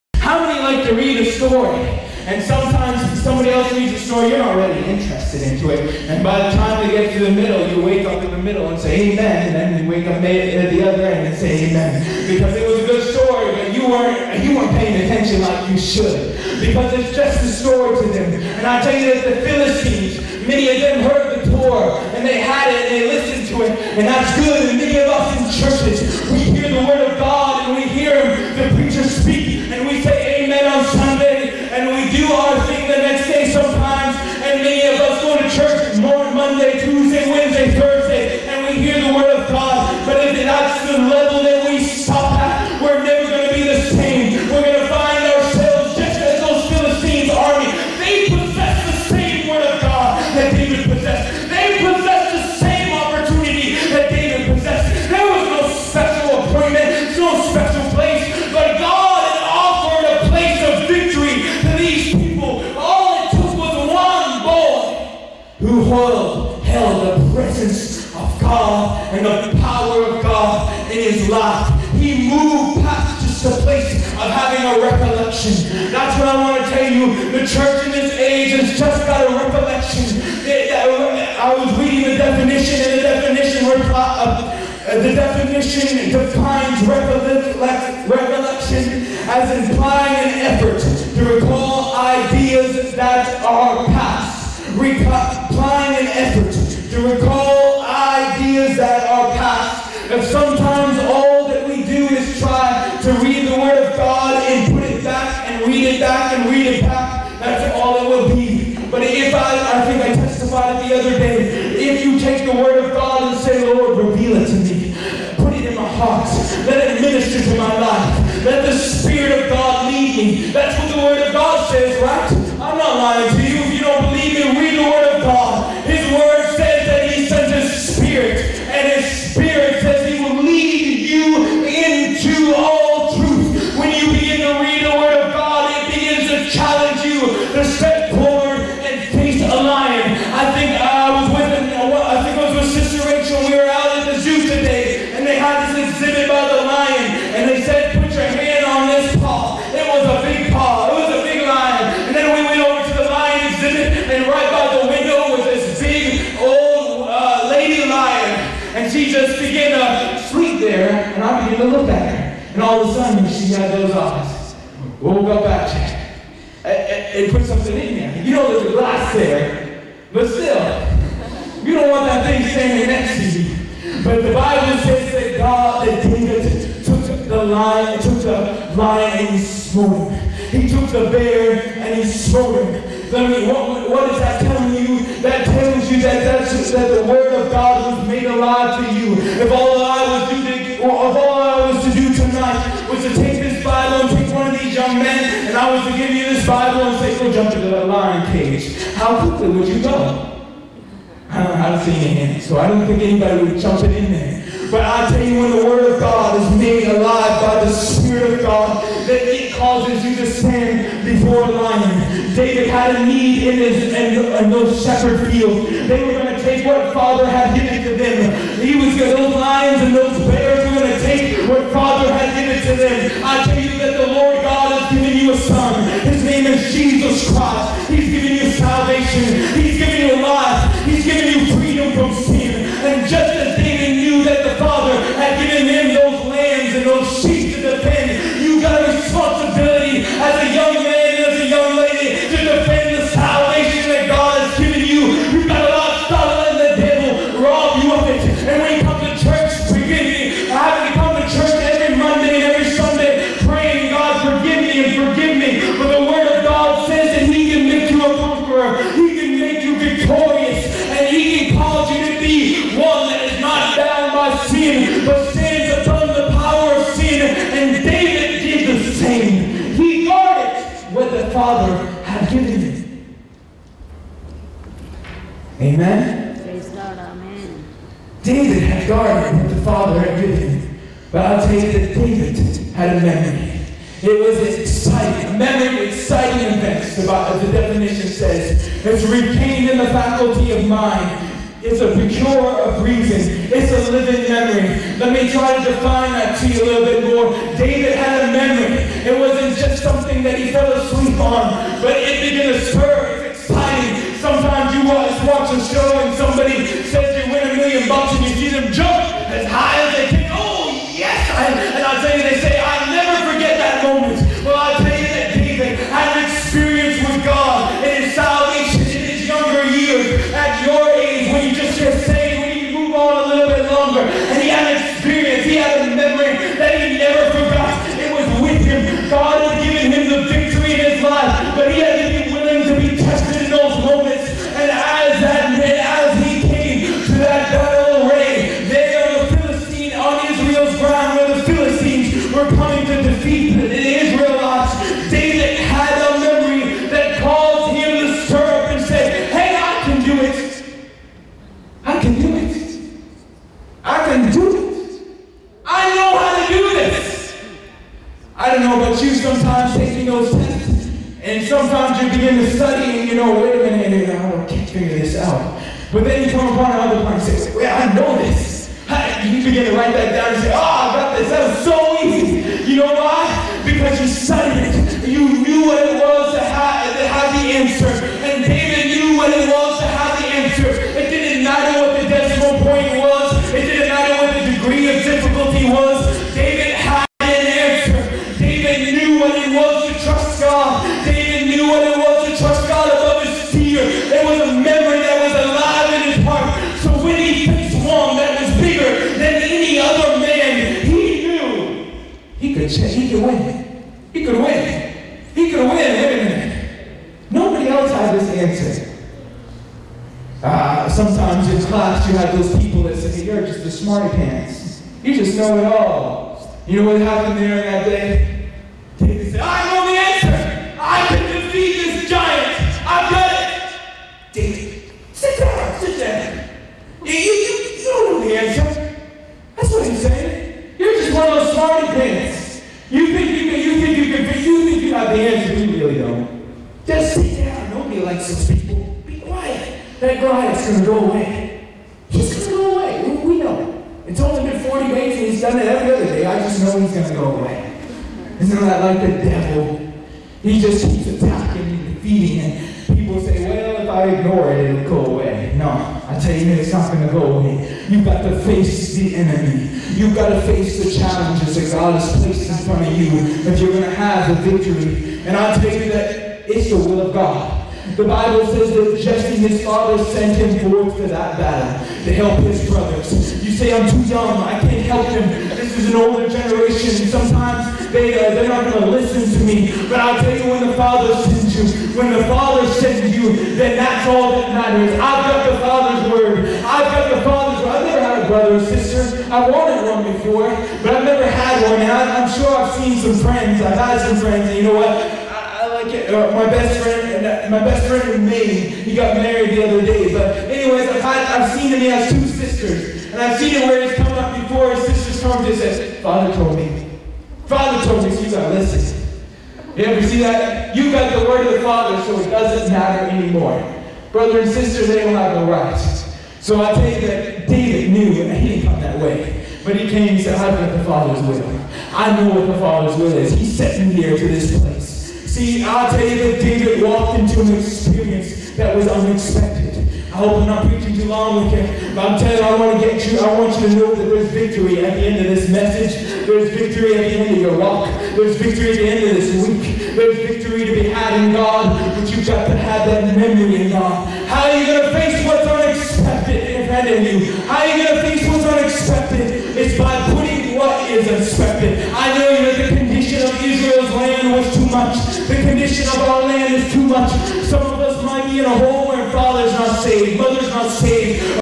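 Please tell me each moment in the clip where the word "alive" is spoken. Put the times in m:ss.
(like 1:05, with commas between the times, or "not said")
3:08, 3:26.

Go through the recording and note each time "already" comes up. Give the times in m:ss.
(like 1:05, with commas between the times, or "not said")
0:04.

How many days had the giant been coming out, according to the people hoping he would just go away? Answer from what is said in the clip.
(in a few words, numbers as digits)
40.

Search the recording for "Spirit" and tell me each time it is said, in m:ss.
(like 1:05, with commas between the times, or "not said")
1:58, 3:27.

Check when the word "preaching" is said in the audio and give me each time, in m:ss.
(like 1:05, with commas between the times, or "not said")
8:50.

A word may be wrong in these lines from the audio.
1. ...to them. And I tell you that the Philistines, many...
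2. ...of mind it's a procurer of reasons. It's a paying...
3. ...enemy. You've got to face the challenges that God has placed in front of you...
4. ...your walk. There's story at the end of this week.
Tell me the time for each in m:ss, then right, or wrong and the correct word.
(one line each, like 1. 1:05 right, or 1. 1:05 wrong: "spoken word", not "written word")
1. 0:18 right
2. 4:50 wrong: "living", not "paying"
3. 7:39 right
4. 8:57 wrong: "victory", not "story".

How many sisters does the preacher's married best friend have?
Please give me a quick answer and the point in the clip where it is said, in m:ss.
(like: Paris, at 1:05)
2, at 8:22.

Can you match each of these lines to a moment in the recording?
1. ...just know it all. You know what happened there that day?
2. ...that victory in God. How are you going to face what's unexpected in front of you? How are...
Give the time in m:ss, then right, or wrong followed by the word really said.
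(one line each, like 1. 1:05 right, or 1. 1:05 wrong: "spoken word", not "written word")
1. 6:55 right
2. 9:02 wrong: "memory", not "victory".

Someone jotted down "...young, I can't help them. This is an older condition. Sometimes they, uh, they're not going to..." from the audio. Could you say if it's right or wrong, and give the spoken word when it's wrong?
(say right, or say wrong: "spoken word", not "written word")
wrong: "generation", not "condition".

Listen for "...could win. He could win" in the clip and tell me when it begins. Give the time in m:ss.
6:44.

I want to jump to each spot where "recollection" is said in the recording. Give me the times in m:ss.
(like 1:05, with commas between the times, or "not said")
1:14, 1:19, 1:26.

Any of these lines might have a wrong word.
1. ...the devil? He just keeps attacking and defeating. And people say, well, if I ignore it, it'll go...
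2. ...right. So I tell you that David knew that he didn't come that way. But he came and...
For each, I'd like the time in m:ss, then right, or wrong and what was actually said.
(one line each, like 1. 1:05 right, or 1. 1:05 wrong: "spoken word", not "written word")
1. 7:29 right
2. 8:35 right.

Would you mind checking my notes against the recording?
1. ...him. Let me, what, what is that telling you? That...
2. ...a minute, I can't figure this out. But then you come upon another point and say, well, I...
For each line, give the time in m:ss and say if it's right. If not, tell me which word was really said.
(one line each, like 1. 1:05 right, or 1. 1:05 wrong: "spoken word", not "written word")
1. 3:02 right
2. 6:03 right.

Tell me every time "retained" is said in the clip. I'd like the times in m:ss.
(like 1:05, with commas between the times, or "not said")
4:49.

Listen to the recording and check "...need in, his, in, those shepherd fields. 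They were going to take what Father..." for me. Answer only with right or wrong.
right.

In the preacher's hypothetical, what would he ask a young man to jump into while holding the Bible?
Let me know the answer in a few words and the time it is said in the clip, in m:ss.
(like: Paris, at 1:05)
Lion cage, at 3:17.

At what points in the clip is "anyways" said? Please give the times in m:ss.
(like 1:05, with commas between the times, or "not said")
8:20.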